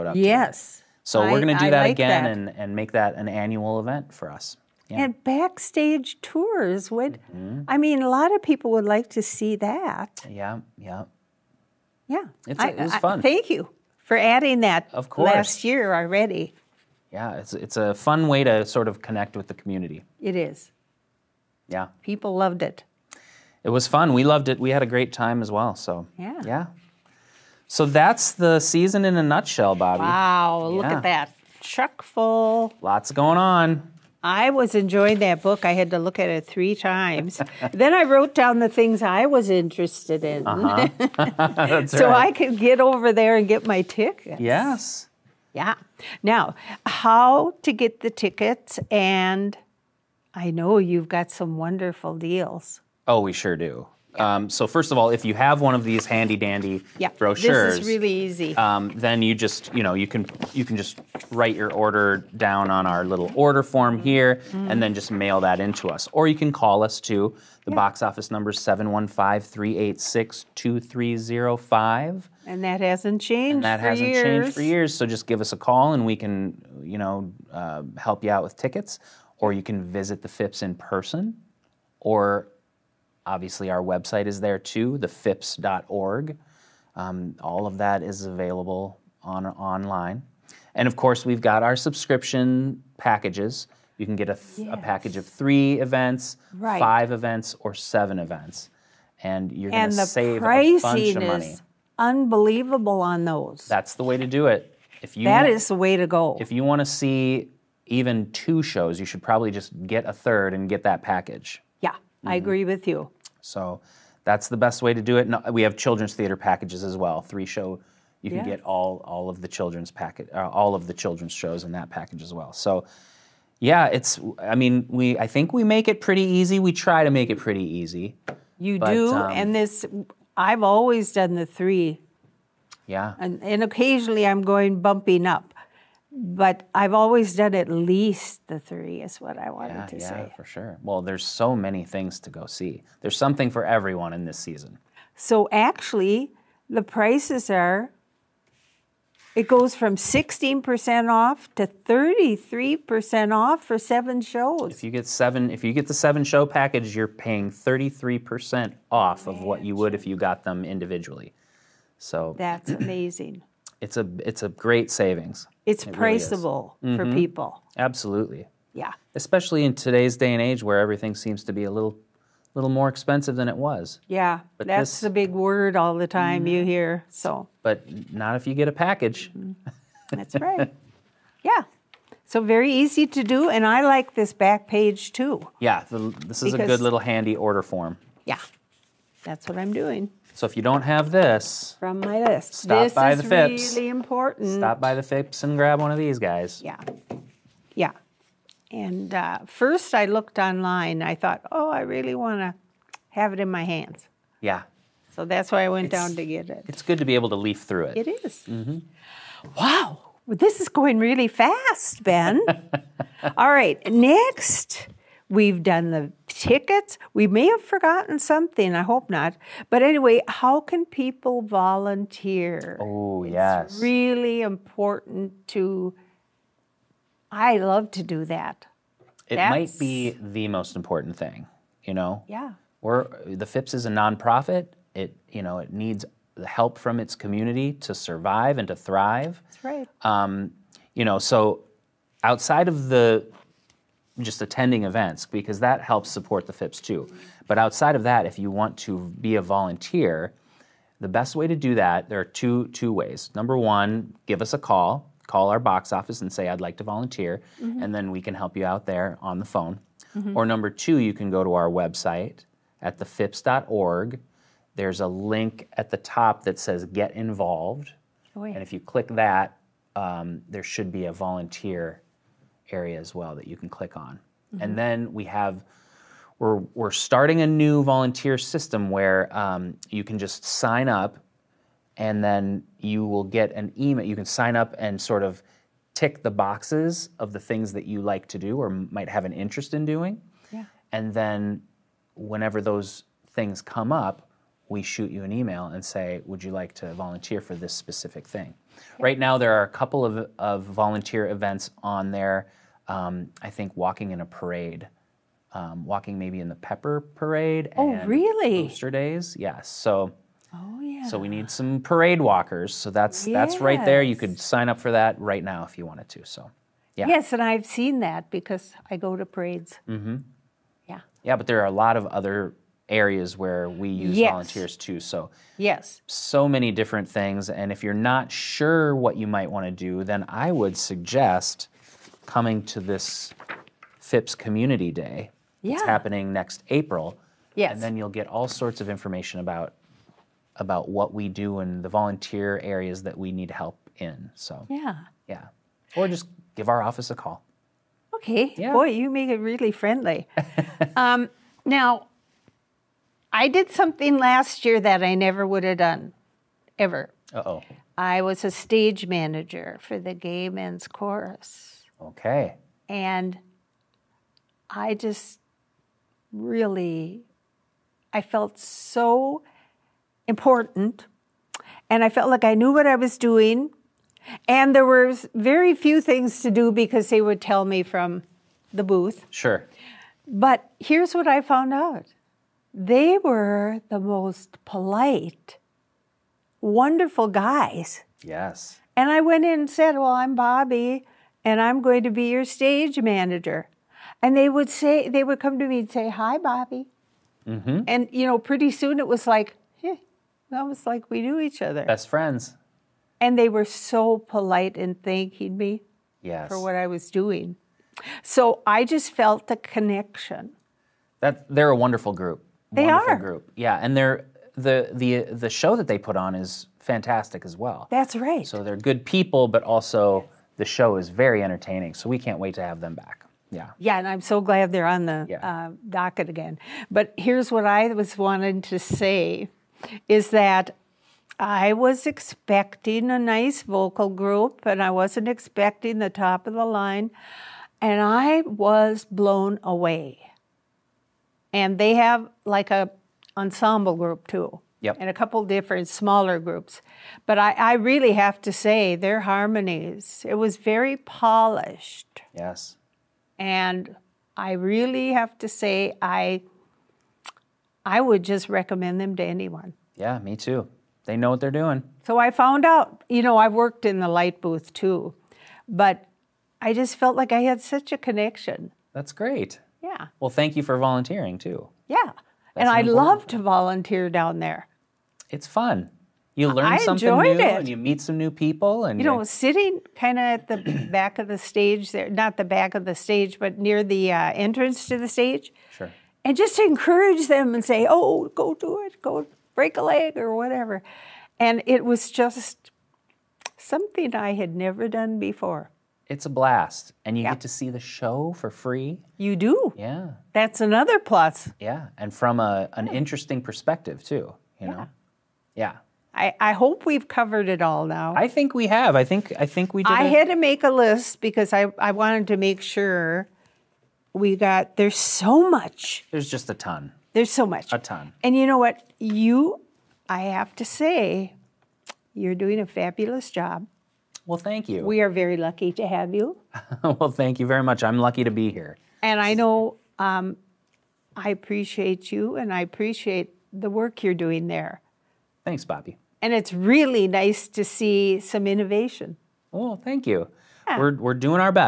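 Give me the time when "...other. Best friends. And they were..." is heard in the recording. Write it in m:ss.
6:41.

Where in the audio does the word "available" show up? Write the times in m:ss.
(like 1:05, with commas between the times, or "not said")
1:28.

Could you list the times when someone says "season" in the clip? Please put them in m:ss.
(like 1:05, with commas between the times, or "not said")
0:28, 2:24.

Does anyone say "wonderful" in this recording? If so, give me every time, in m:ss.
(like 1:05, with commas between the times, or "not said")
0:51, 6:26, 6:51.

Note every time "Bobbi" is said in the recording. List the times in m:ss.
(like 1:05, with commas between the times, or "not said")
0:29, 6:30, 6:36, 8:55.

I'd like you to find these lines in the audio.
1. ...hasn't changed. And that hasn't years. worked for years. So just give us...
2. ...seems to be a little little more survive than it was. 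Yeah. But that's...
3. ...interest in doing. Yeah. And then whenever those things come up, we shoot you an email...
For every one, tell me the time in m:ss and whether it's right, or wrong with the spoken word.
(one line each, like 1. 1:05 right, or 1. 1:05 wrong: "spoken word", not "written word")
1. 1:12 wrong: "changed", not "worked"
2. 2:51 wrong: "expensive", not "survive"
3. 4:49 right.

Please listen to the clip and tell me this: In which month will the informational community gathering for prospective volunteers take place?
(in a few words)
April.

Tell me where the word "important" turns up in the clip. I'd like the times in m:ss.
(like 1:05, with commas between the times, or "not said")
3:13, 3:44, 3:50, 6:10.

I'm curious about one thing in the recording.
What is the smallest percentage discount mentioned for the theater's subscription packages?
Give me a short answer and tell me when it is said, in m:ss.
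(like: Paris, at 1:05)
16%, at 2:29.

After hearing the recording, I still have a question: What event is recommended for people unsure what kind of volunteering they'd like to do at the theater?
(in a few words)
Phipps Community Day.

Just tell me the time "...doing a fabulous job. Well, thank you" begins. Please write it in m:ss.
8:42.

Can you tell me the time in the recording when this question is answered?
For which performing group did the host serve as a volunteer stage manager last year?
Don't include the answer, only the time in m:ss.
6:00.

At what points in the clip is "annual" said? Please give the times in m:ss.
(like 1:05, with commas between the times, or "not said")
0:03.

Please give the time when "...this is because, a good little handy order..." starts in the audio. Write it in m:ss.
3:06.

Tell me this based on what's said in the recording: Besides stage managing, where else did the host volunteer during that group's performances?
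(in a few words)
light booth.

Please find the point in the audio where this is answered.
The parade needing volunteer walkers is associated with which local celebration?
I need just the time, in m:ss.
5:08.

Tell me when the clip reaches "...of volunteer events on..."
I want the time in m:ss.
5:00.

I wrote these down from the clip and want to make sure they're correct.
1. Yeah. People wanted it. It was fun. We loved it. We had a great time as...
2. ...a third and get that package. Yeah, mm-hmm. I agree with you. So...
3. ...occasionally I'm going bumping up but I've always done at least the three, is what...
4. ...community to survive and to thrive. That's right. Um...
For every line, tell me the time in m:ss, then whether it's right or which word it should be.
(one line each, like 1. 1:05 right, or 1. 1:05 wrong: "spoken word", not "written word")
1. 0:21 wrong: "loved", not "wanted"
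2. 1:50 right
3. 2:13 right
4. 3:57 right.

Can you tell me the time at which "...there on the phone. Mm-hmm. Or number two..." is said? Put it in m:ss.
4:18.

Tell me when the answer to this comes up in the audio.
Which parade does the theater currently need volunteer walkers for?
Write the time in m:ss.
5:06.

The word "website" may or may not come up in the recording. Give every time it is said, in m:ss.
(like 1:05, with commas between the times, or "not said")
1:23, 4:21.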